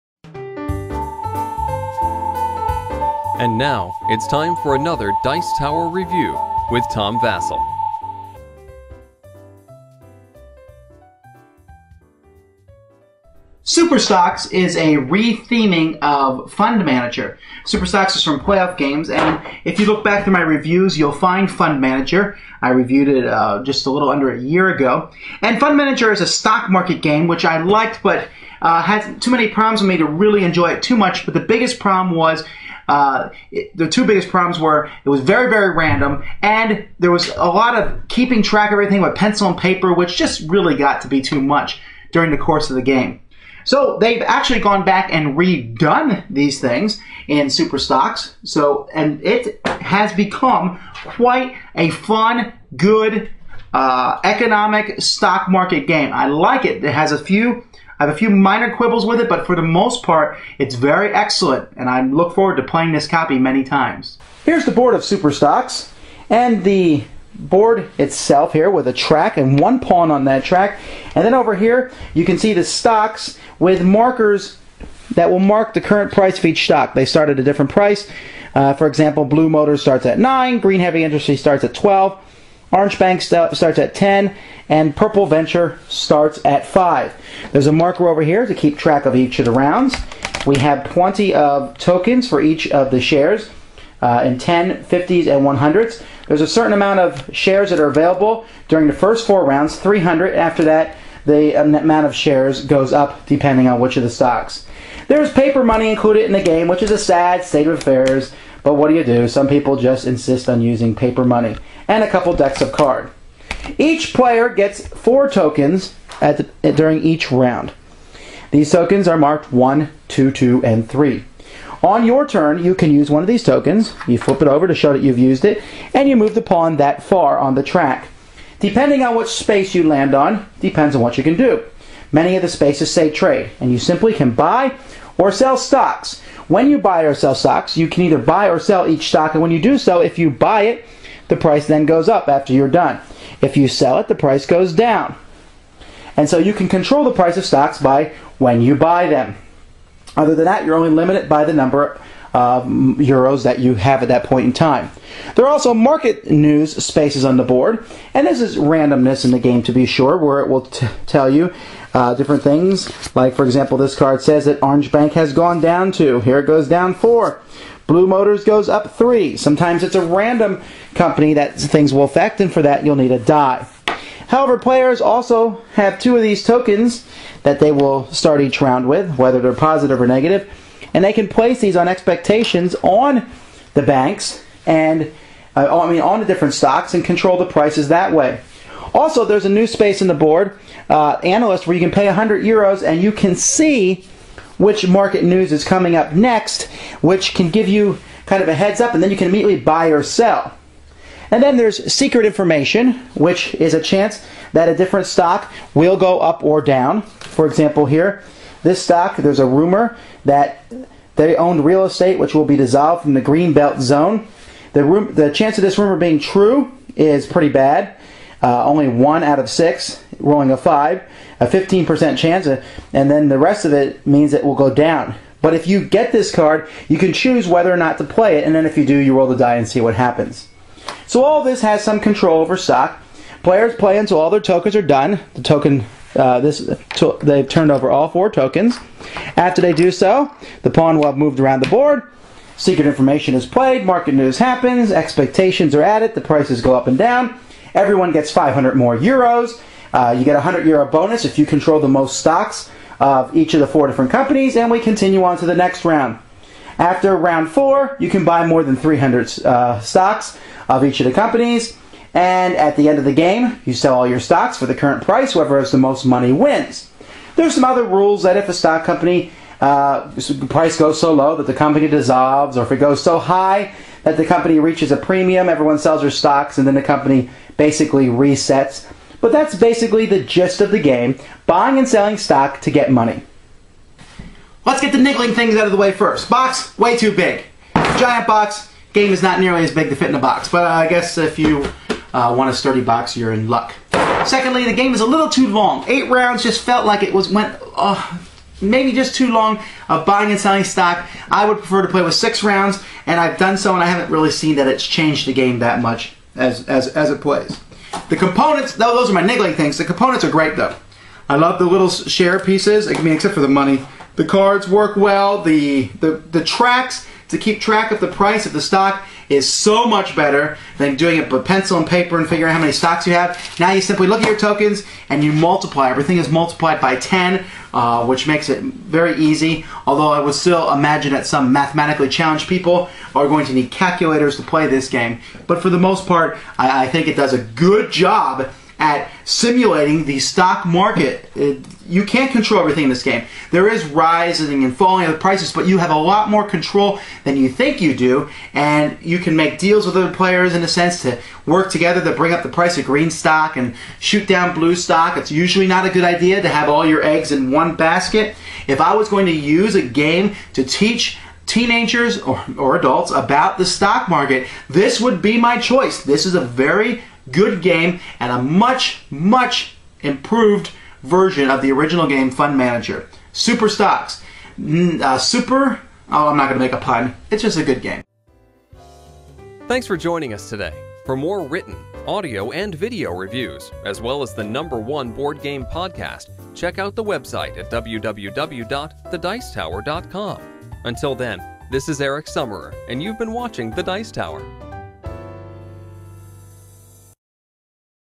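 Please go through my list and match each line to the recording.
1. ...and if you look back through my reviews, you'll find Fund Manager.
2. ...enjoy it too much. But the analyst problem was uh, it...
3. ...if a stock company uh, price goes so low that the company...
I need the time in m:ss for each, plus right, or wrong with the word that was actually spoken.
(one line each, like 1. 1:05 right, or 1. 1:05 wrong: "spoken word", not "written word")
1. 0:19 right
2. 0:30 wrong: "biggest", not "analyst"
3. 4:28 right.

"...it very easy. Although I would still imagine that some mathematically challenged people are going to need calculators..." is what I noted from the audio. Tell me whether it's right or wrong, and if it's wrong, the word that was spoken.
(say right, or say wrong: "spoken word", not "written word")
right.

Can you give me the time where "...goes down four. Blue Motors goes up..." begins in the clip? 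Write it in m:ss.
2:46.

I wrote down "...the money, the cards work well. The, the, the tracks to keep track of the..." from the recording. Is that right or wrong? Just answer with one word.
right.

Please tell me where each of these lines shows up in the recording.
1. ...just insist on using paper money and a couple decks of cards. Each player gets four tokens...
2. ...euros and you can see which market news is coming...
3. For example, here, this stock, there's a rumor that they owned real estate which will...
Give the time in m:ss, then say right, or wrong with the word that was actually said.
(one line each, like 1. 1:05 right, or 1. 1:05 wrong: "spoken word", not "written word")
1. 1:49 right
2. 3:12 right
3. 3:27 right.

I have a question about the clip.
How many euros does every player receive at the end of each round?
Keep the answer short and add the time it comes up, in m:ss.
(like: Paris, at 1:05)
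500, at 4:08.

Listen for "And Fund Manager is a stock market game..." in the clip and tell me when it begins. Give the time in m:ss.
0:25.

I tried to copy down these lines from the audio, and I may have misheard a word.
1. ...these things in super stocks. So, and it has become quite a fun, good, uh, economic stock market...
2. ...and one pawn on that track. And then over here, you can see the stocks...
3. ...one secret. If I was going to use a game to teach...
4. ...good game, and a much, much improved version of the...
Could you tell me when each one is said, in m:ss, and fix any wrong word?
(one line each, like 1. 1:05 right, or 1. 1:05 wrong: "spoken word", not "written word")
1. 0:46 right
2. 1:09 right
3. 5:57 wrong: "basket", not "secret"
4. 6:07 right.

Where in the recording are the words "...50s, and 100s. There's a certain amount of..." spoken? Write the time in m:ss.
1:34.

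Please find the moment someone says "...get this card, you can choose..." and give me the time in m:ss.
3:45.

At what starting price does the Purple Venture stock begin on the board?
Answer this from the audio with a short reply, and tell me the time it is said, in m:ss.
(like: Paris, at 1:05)
5, at 1:26.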